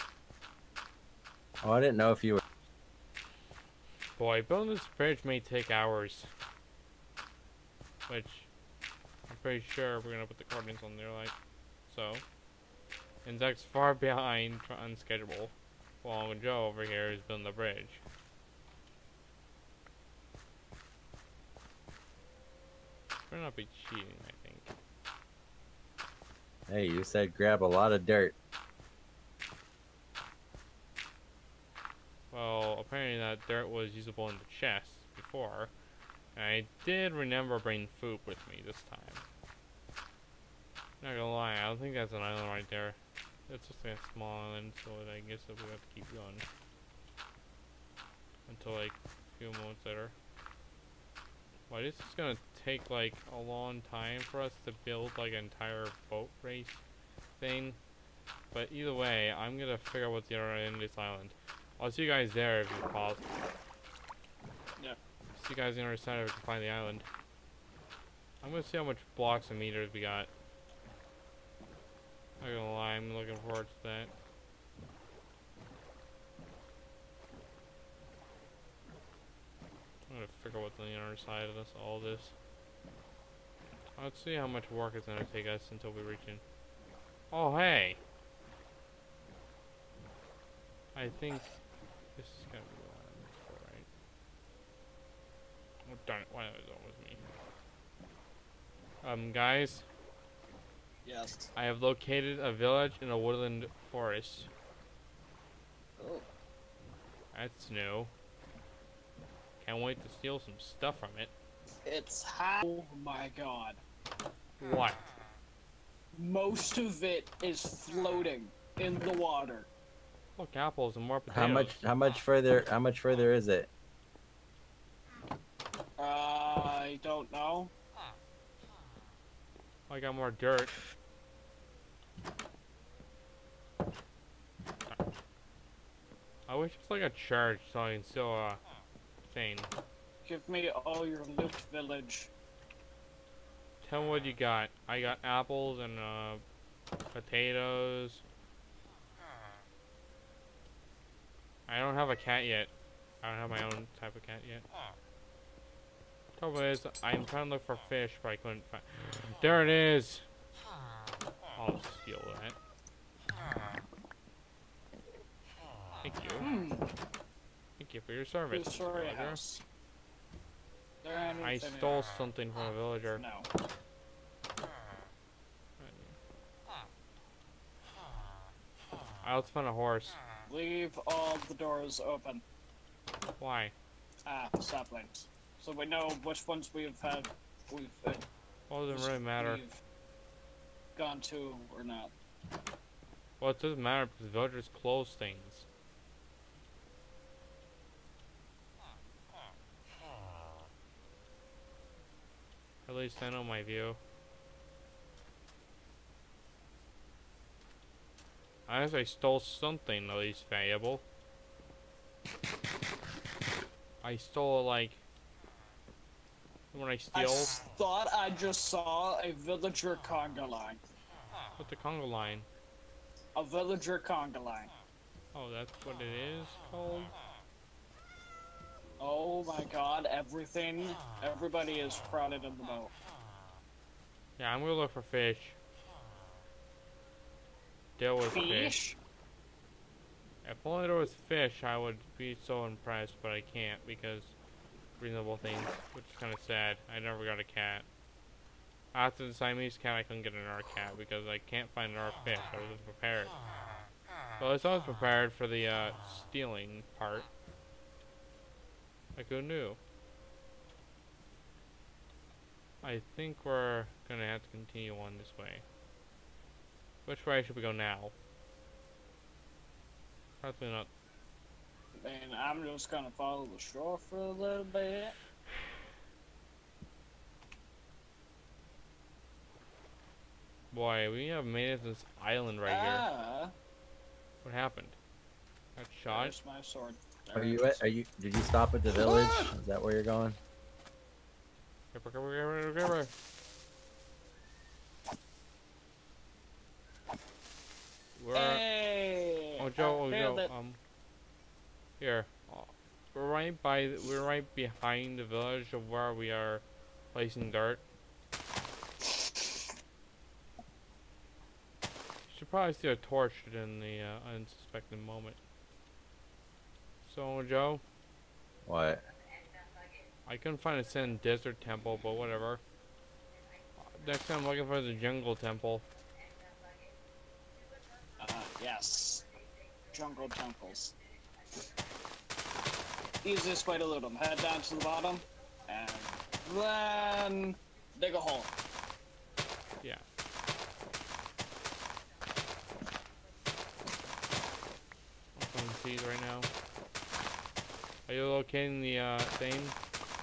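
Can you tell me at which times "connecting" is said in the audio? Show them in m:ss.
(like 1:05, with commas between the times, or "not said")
not said.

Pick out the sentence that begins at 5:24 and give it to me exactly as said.
Next time I'm looking for the jungle temple.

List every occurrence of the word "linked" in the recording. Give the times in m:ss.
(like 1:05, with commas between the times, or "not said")
not said.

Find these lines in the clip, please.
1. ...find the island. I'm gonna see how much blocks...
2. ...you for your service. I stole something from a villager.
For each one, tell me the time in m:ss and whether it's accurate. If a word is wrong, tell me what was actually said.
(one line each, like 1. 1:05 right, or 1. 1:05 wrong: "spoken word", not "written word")
1. 1:06 right
2. 2:47 right.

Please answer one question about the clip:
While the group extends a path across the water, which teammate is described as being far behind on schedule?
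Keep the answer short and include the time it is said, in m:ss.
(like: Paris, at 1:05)
Zac, at 0:13.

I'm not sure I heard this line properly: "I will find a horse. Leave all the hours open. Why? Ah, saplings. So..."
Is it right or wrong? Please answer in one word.
wrong.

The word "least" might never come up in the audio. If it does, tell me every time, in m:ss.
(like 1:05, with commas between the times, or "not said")
3:22, 3:30.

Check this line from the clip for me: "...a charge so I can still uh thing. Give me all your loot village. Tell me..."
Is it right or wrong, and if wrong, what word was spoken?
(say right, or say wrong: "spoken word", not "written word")
right.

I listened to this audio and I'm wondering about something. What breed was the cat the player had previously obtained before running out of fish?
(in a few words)
Siamese.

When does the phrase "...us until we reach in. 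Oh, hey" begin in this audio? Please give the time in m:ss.
1:25.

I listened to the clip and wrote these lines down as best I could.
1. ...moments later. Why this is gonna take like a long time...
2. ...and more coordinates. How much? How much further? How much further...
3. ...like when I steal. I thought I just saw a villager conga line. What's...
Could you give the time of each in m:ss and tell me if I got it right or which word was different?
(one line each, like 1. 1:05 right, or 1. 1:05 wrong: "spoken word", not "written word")
1. 0:49 right
2. 2:00 wrong: "potatoes", not "coordinates"
3. 3:34 right.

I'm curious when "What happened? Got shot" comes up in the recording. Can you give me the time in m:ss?
4:44.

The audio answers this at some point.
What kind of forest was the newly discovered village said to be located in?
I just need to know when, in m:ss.
1:43.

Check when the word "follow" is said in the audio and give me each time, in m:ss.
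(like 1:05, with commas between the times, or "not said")
4:33.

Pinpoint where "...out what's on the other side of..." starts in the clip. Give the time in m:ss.
1:20.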